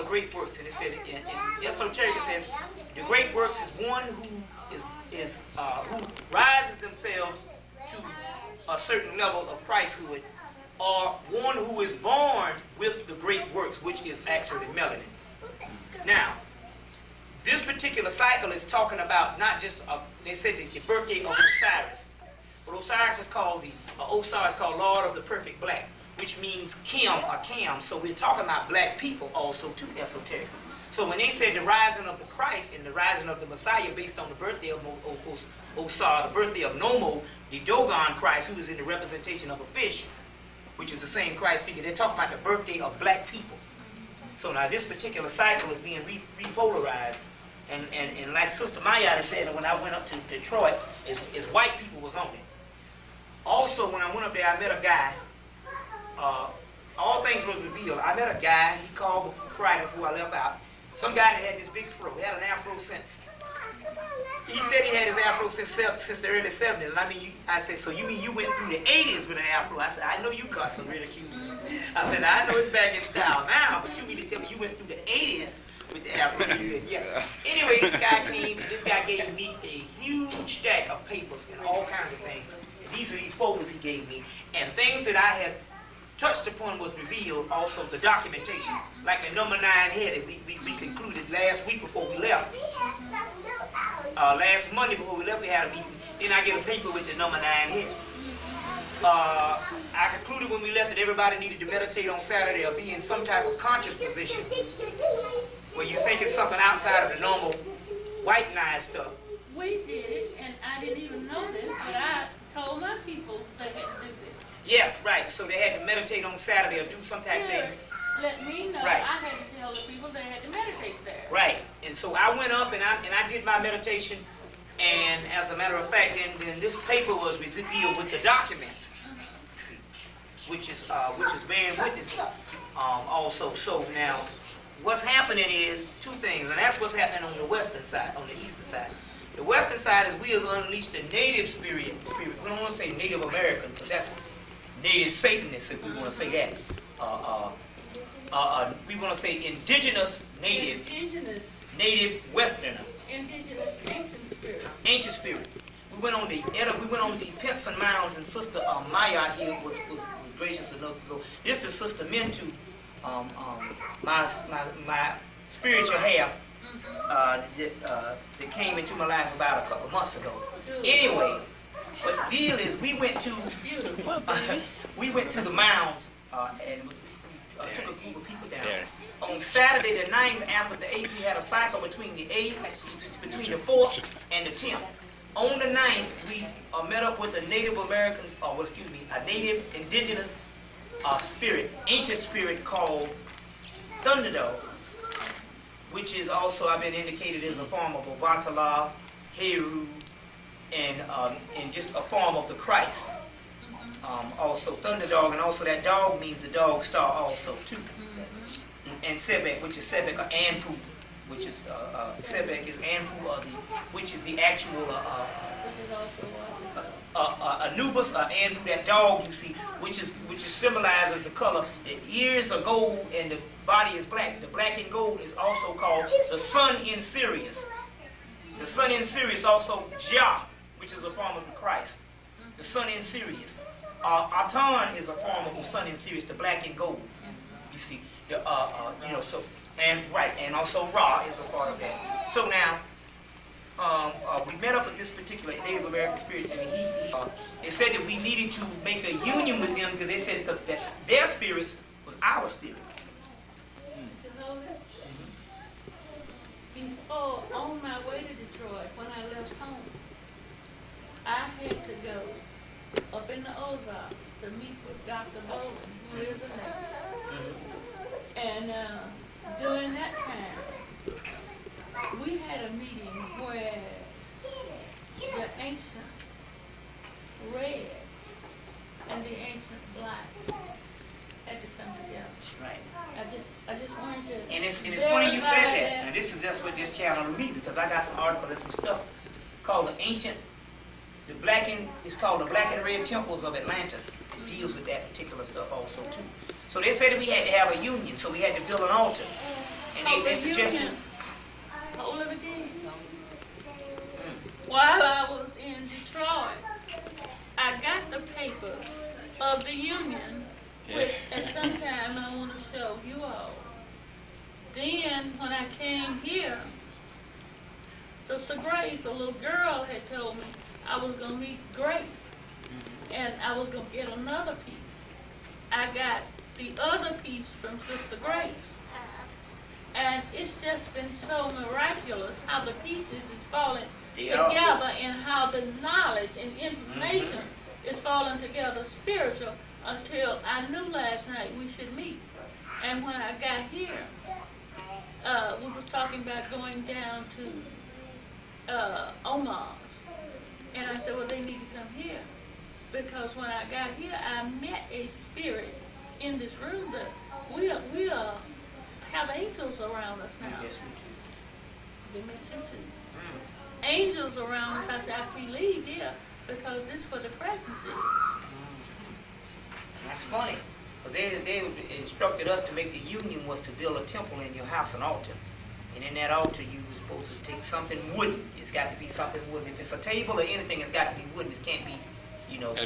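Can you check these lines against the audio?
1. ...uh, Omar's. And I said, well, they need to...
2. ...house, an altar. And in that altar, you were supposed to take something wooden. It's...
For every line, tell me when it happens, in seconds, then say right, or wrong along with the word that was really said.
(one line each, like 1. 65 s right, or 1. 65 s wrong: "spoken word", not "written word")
1. 348 s right
2. 374 s right.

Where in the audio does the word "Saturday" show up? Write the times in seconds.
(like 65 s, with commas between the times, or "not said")
102 s, 116 s, 120 s, 179 s.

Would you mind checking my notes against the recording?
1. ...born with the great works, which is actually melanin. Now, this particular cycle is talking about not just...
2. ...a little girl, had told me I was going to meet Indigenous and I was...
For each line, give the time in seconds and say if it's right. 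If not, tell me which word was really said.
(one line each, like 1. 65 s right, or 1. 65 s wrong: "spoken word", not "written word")
1. 11 s right
2. 319 s wrong: "Grace", not "Indigenous".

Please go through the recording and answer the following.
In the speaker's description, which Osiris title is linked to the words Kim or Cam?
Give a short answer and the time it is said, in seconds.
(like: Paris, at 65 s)
Lord of the Perfect Black, at 24 s.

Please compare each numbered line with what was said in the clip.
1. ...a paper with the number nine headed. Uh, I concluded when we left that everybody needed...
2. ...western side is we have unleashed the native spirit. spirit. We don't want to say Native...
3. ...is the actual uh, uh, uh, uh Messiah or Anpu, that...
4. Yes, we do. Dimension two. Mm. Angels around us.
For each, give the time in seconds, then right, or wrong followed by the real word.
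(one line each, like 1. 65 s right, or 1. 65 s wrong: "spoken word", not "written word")
1. 96 s right
2. 139 s right
3. 214 s wrong: "Anubis", not "Messiah"
4. 360 s right.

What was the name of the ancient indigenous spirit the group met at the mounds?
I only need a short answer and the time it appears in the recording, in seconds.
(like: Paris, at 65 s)
Thunderdove, at 194 s.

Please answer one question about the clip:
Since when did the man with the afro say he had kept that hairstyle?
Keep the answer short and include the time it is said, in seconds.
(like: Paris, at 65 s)
early 70s, at 66 s.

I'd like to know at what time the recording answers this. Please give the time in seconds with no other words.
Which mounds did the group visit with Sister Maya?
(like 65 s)
157 s.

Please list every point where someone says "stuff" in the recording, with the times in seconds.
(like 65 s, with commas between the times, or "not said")
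108 s, 288 s, 295 s.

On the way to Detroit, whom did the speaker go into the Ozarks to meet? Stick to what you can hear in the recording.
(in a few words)
Dr. Bowen.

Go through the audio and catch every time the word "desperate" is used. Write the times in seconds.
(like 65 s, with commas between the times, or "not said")
not said.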